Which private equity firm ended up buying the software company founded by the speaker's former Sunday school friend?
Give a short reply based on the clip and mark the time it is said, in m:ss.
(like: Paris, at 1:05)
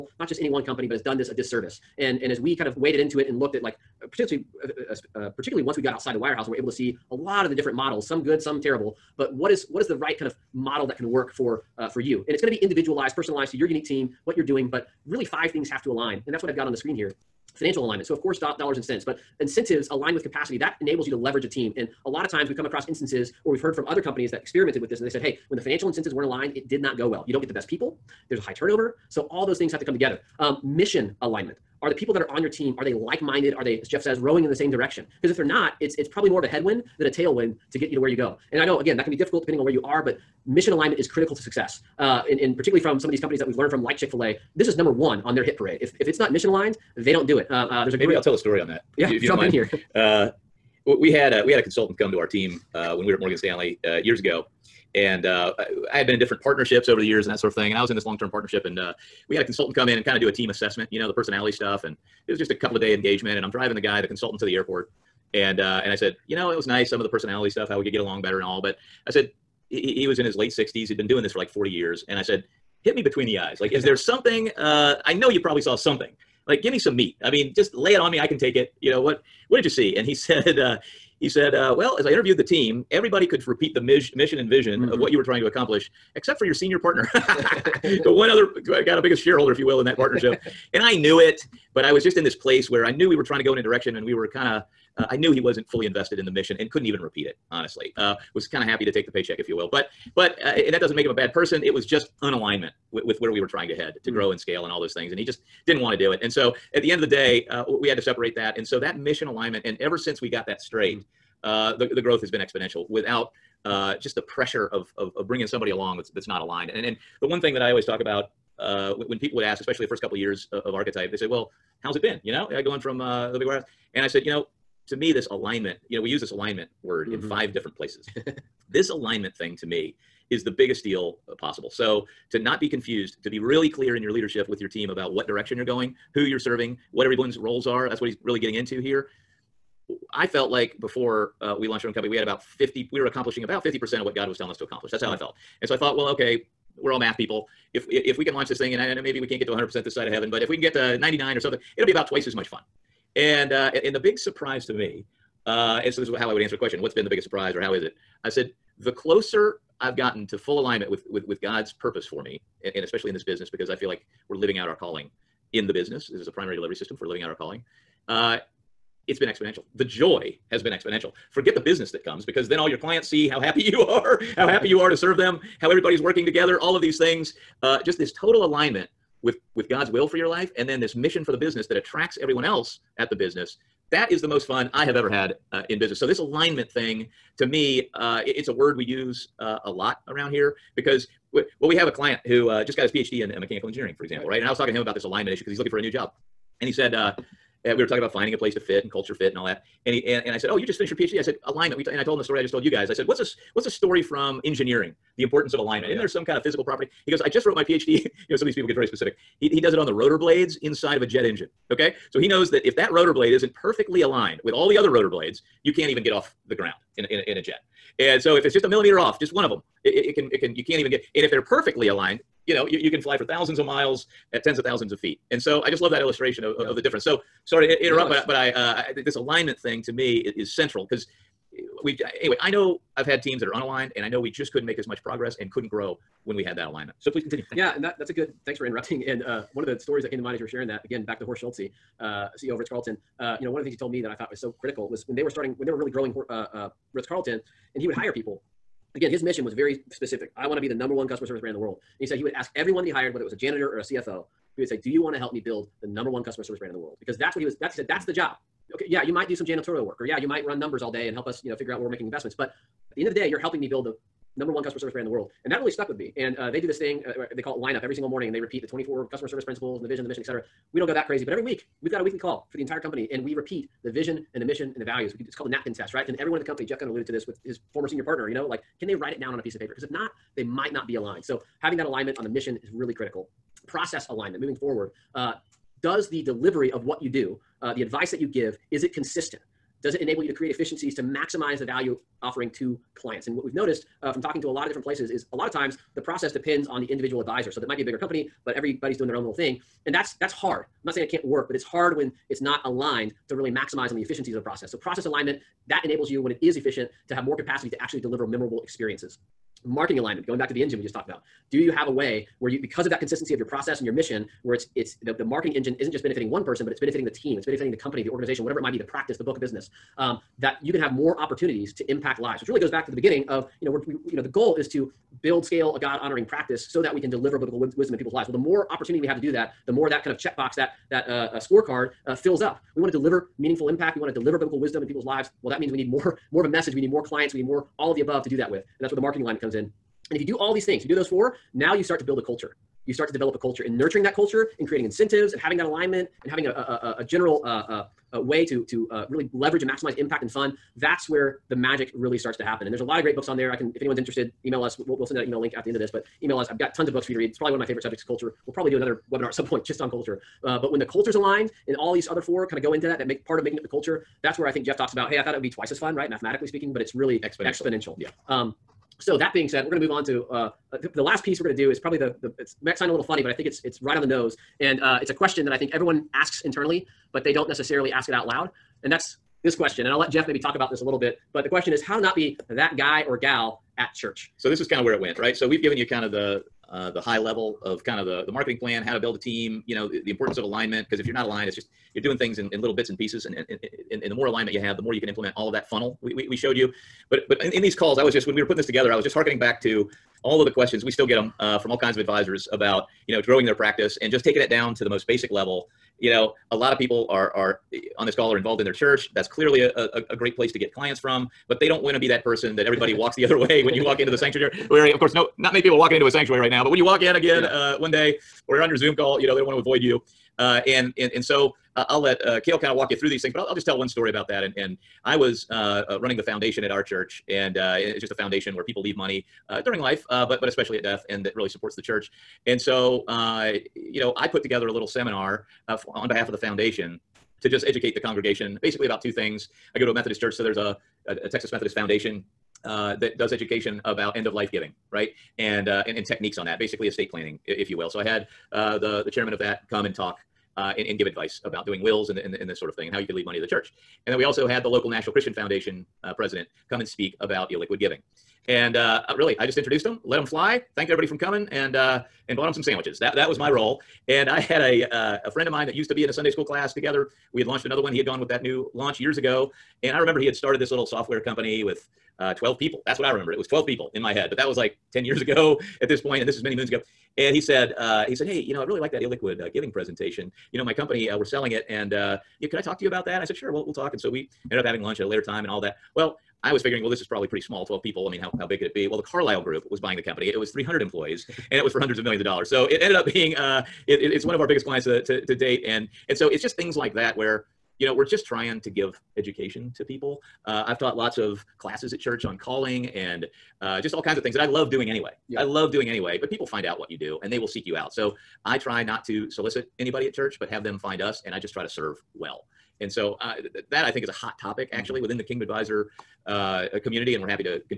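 The Carlyle Group, at 8:09.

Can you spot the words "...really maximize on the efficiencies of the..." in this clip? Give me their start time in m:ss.
5:03.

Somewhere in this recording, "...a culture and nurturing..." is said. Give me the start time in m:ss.
5:43.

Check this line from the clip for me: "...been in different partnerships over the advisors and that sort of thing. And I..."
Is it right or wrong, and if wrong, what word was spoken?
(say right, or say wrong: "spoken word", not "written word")
wrong: "years", not "advisors".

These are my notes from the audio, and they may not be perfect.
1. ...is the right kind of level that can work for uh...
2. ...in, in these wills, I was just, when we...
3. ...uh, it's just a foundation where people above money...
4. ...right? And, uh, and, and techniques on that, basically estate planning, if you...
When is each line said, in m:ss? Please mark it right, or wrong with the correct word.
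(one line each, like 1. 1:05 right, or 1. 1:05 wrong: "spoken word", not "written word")
1. 0:09 wrong: "model", not "level"
2. 6:37 wrong: "calls", not "wills"
3. 7:07 wrong: "leave", not "above"
4. 7:24 right.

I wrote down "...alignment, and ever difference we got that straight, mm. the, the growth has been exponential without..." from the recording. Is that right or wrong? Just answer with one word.
wrong.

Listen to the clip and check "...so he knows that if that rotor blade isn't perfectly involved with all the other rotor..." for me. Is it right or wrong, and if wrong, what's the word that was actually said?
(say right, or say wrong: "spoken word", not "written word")
wrong: "aligned", not "involved".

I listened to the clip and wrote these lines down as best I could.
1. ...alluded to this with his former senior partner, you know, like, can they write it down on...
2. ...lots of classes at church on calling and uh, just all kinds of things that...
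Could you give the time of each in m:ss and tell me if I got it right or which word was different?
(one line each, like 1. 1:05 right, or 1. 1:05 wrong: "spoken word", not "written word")
1. 4:36 right
2. 8:20 right.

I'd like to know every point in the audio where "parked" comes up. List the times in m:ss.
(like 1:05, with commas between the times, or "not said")
not said.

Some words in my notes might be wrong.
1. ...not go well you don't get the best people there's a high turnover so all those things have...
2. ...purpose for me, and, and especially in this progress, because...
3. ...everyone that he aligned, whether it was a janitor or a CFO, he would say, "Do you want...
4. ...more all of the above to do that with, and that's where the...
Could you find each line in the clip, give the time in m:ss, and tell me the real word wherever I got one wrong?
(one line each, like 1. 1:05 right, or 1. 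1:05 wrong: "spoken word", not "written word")
1. 0:26 right
2. 2:41 wrong: "business", not "progress"
3. 4:12 wrong: "hired", not "aligned"
4. 5:37 right.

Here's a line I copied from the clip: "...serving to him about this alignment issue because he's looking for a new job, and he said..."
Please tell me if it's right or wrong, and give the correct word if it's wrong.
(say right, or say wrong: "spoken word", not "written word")
wrong: "talking", not "serving".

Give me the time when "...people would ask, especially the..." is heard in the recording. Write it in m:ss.
1:59.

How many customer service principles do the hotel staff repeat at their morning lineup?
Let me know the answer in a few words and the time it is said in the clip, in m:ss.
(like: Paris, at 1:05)
24, at 4:28.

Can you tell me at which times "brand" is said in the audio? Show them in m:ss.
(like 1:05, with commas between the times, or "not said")
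4:11, 4:16, 4:24.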